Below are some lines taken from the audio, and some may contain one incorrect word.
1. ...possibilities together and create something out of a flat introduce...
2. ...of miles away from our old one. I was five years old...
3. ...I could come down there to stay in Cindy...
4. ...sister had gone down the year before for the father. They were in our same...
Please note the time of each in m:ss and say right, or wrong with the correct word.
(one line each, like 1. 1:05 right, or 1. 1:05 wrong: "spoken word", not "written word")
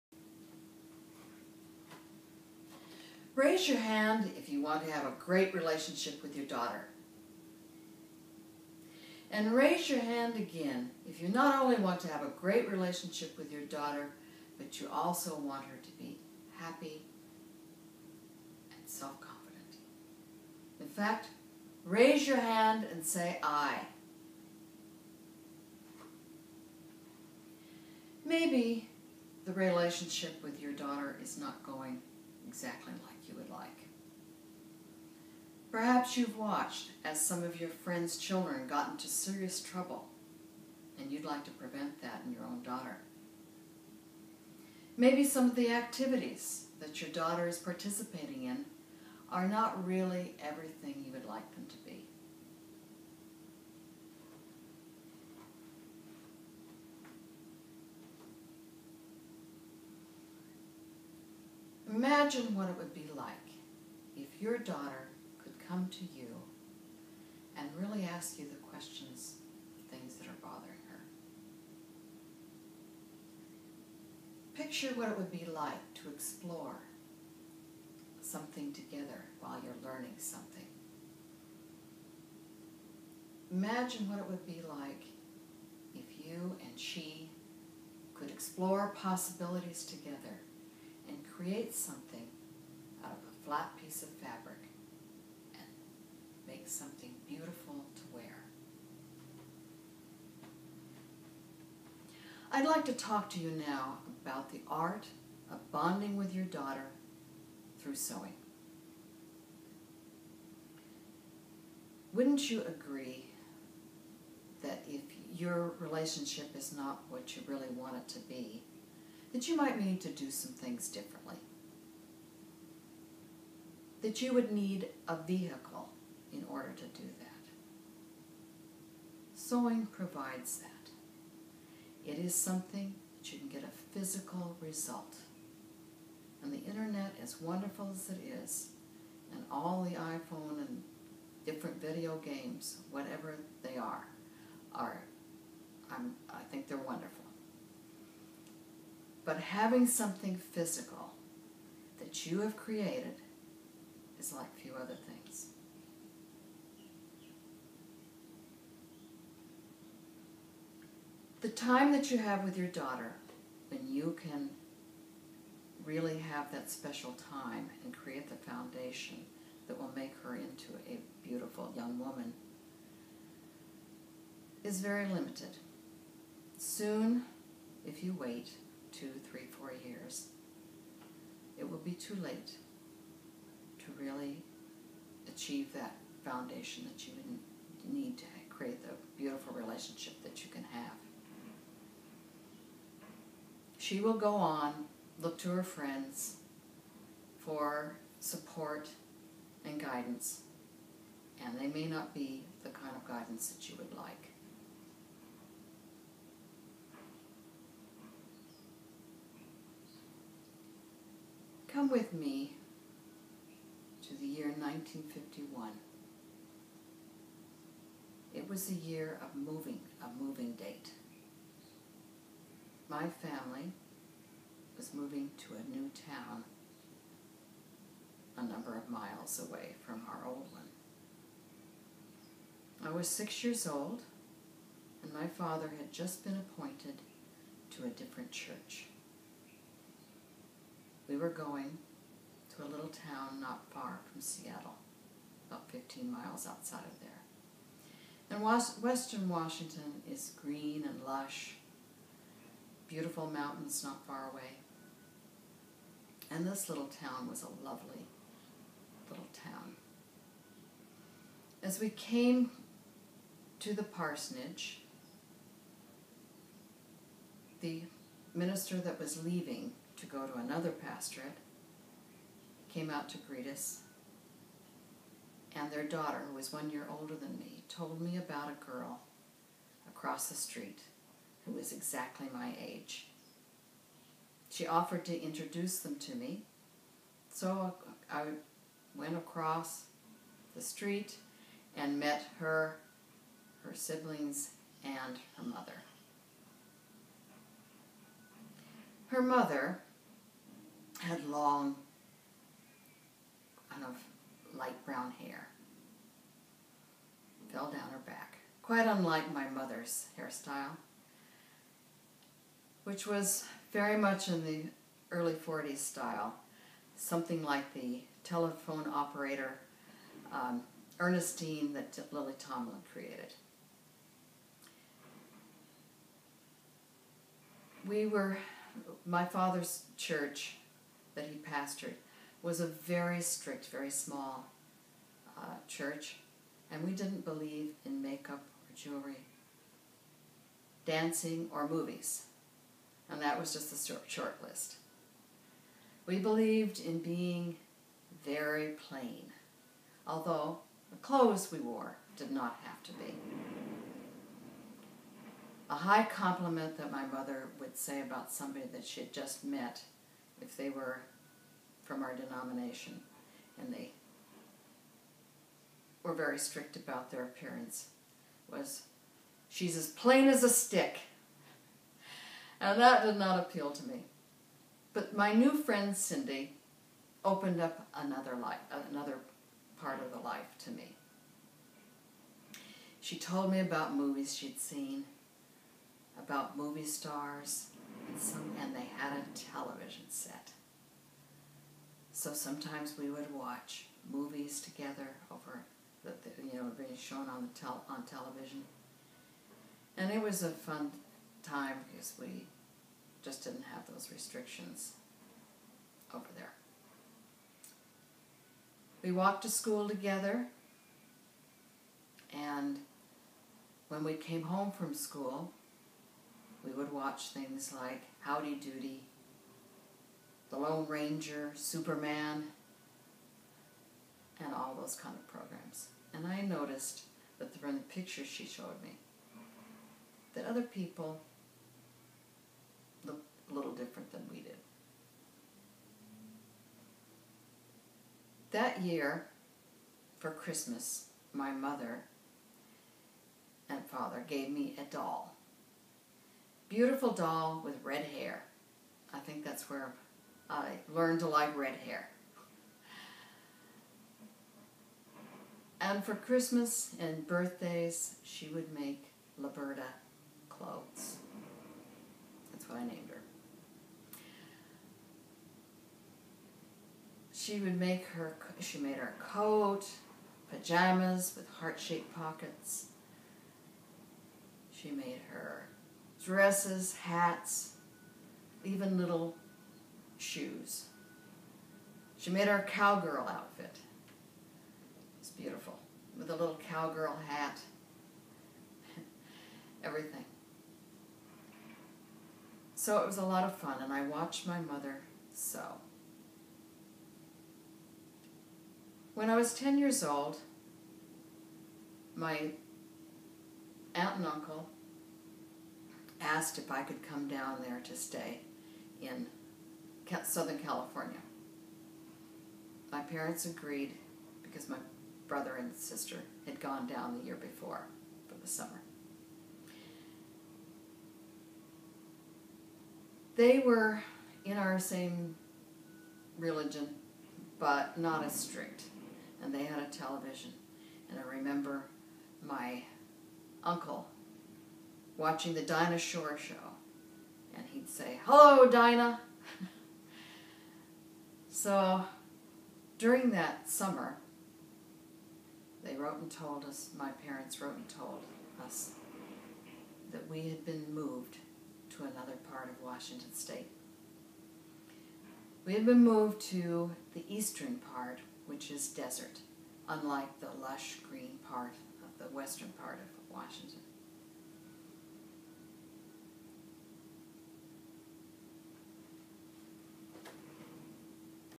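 1. 1:28 wrong: "piece", not "introduce"
2. 3:48 wrong: "six", not "five"
3. 8:26 wrong: "Southern", not "Cindy"
4. 8:35 wrong: "summer", not "father".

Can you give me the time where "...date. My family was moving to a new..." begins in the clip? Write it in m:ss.
3:40.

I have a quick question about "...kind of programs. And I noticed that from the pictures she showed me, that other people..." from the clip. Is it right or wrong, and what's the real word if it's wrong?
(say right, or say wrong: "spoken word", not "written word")
right.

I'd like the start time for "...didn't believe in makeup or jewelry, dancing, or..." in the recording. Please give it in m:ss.
5:36.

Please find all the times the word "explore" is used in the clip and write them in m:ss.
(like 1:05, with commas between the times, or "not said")
1:16, 1:28.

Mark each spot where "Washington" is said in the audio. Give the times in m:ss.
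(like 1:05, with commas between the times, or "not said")
4:09, 9:12, 9:23.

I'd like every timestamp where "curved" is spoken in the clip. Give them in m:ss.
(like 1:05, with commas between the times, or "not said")
not said.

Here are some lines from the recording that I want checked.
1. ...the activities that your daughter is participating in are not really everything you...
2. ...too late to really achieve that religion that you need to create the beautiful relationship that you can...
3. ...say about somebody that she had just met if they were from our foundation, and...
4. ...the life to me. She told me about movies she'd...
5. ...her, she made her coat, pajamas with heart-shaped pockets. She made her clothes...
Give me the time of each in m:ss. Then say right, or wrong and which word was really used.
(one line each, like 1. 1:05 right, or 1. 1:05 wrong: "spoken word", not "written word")
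1. 0:45 right
2. 3:01 wrong: "foundation", not "religion"
3. 5:57 wrong: "denomination", not "foundation"
4. 6:20 right
5. 7:48 wrong: "dresses", not "clothes".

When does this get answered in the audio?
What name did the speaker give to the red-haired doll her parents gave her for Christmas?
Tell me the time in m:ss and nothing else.
7:39.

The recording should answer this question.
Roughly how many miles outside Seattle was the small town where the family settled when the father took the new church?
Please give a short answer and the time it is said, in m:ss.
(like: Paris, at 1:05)
15, at 4:05.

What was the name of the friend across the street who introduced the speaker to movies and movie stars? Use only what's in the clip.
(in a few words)
Cindy.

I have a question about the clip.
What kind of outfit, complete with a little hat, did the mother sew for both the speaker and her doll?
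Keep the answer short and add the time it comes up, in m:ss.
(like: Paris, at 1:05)
cowgirl outfit, at 8:02.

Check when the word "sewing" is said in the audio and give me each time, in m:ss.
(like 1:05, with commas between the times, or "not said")
1:47, 2:09.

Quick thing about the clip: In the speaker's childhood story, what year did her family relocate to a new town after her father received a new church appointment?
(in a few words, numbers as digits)
1951.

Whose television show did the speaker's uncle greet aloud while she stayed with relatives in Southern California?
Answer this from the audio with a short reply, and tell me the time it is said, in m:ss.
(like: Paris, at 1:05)
Dinah Shore, at 8:55.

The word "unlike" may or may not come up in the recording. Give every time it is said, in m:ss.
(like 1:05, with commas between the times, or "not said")
5:08, 9:19.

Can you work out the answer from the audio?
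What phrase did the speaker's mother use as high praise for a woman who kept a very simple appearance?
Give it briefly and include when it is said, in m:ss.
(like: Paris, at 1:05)
plain as a stick, at 6:09.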